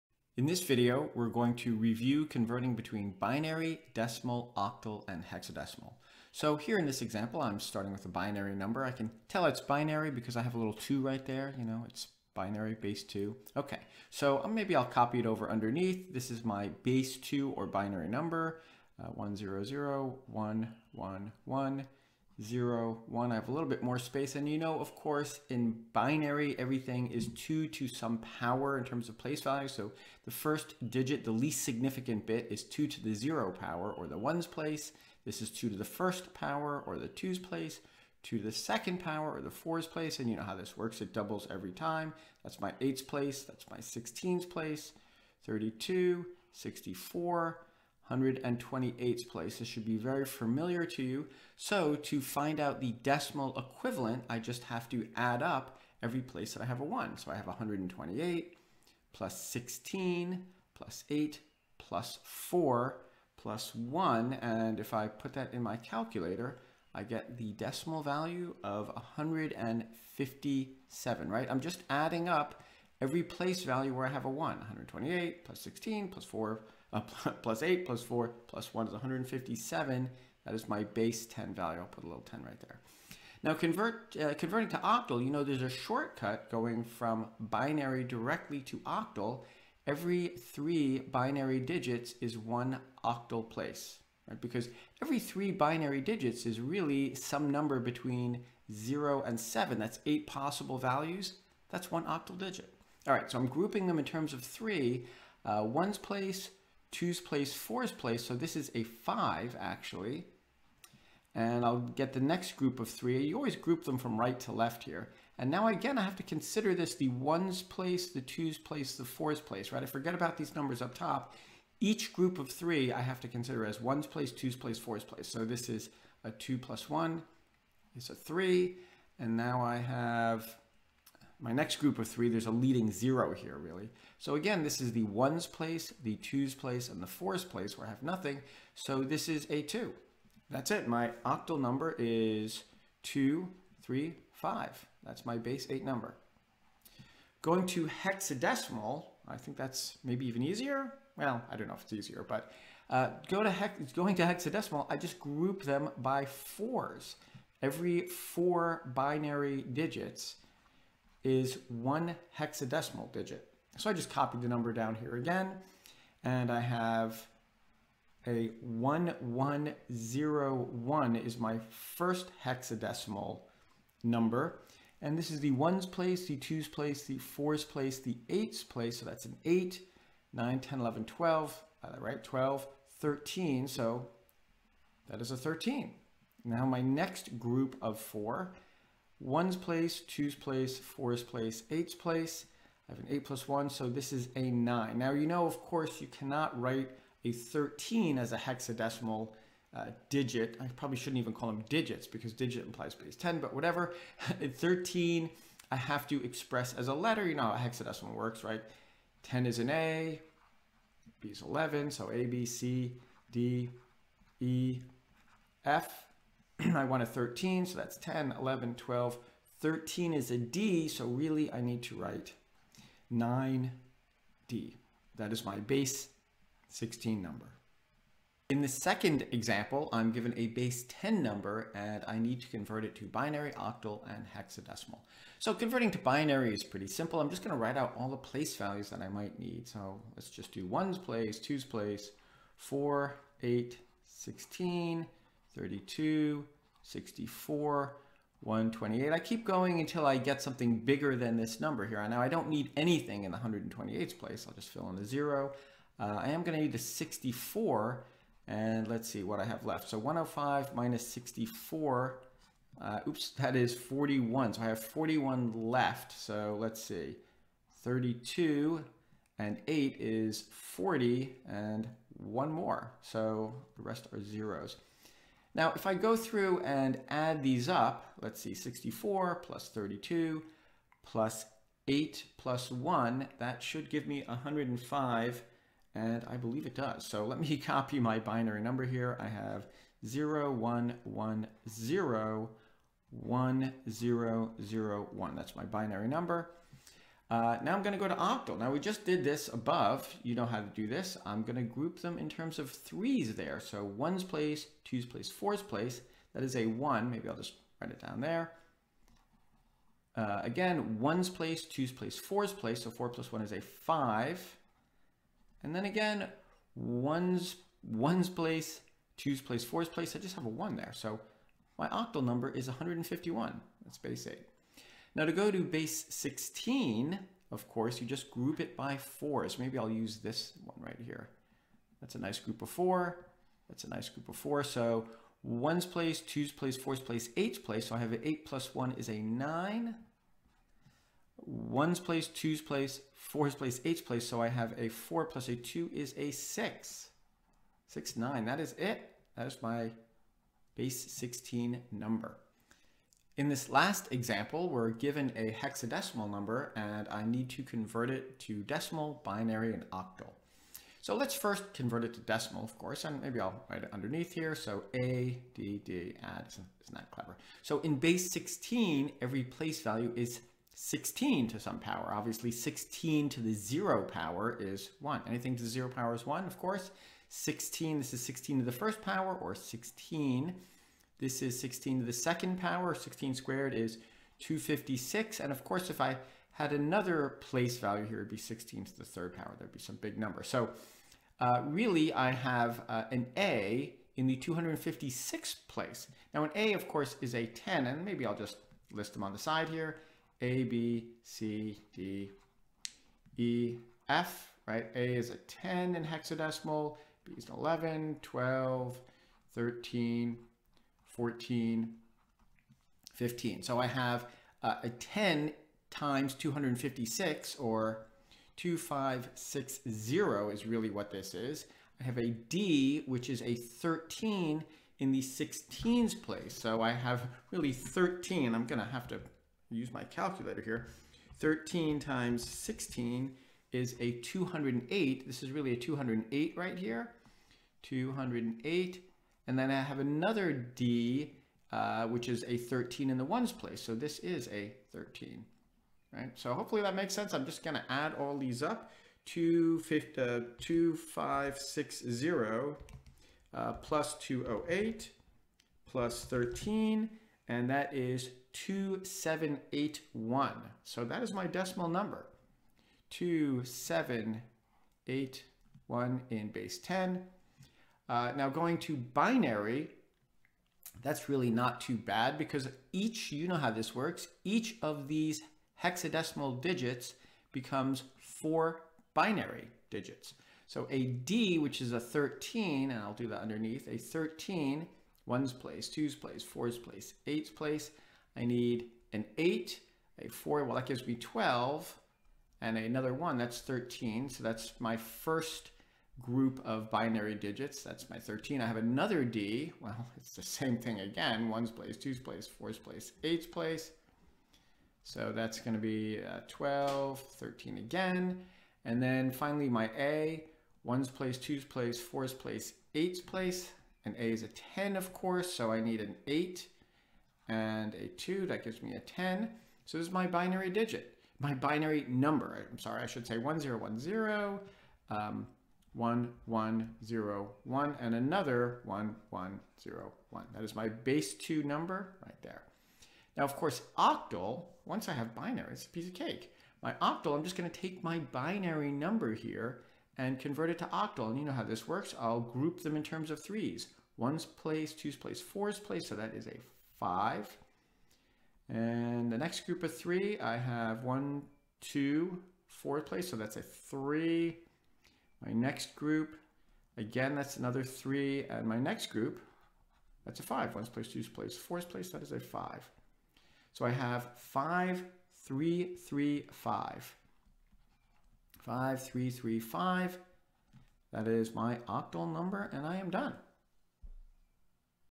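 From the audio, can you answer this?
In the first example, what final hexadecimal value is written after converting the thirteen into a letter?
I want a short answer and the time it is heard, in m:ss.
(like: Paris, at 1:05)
9D, at 3:43.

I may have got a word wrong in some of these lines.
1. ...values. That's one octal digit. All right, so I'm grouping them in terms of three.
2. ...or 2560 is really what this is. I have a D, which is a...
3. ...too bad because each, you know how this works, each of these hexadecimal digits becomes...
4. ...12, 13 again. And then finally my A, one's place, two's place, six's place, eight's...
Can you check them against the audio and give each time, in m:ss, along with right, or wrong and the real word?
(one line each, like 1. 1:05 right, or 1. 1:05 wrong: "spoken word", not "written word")
1. 1:40 right
2. 6:57 right
3. 7:51 right
4. 8:26 wrong: "four", not "six".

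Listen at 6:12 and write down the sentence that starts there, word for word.
Obviously 16 to the zero power is one.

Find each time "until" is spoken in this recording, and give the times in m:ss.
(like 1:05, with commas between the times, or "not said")
4:09.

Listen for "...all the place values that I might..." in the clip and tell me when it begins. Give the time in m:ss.
3:57.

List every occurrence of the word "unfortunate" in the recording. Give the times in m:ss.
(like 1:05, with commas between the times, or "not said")
not said.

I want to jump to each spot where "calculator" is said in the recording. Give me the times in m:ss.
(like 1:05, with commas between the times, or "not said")
1:05, 7:10.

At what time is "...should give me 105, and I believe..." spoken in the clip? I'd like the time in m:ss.
4:43.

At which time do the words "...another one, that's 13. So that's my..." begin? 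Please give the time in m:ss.
8:12.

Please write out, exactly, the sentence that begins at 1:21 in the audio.
I'll put a little 10 right there.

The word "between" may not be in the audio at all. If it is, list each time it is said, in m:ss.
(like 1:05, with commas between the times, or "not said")
0:02, 1:37.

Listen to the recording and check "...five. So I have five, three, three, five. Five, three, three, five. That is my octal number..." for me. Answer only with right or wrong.
right.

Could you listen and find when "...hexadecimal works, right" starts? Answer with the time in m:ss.
3:27.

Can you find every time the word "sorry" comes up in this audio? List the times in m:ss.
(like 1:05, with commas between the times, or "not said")
8:42.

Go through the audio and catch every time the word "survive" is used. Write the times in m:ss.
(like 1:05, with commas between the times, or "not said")
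not said.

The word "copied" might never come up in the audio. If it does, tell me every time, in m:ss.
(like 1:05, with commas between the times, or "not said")
2:44.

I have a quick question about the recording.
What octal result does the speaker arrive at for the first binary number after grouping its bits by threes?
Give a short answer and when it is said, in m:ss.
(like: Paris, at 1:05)
235, at 2:23.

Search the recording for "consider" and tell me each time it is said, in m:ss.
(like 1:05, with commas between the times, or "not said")
1:56, 2:03.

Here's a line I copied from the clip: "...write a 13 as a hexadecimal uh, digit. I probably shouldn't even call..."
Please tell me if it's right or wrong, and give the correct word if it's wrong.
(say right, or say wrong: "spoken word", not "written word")
right.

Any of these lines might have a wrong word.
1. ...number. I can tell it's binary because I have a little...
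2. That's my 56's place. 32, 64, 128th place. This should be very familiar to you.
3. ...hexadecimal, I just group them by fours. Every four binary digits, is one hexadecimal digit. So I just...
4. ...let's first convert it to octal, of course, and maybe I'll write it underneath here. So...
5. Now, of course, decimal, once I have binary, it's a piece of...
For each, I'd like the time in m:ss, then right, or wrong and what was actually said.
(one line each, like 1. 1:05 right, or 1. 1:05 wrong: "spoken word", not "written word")
1. 0:08 right
2. 0:43 wrong: "16", not "56"
3. 2:34 right
4. 6:01 wrong: "decimal", not "octal"
5. 8:53 wrong: "octal", not "decimal".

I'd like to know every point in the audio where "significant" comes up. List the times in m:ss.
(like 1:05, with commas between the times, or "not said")
0:31.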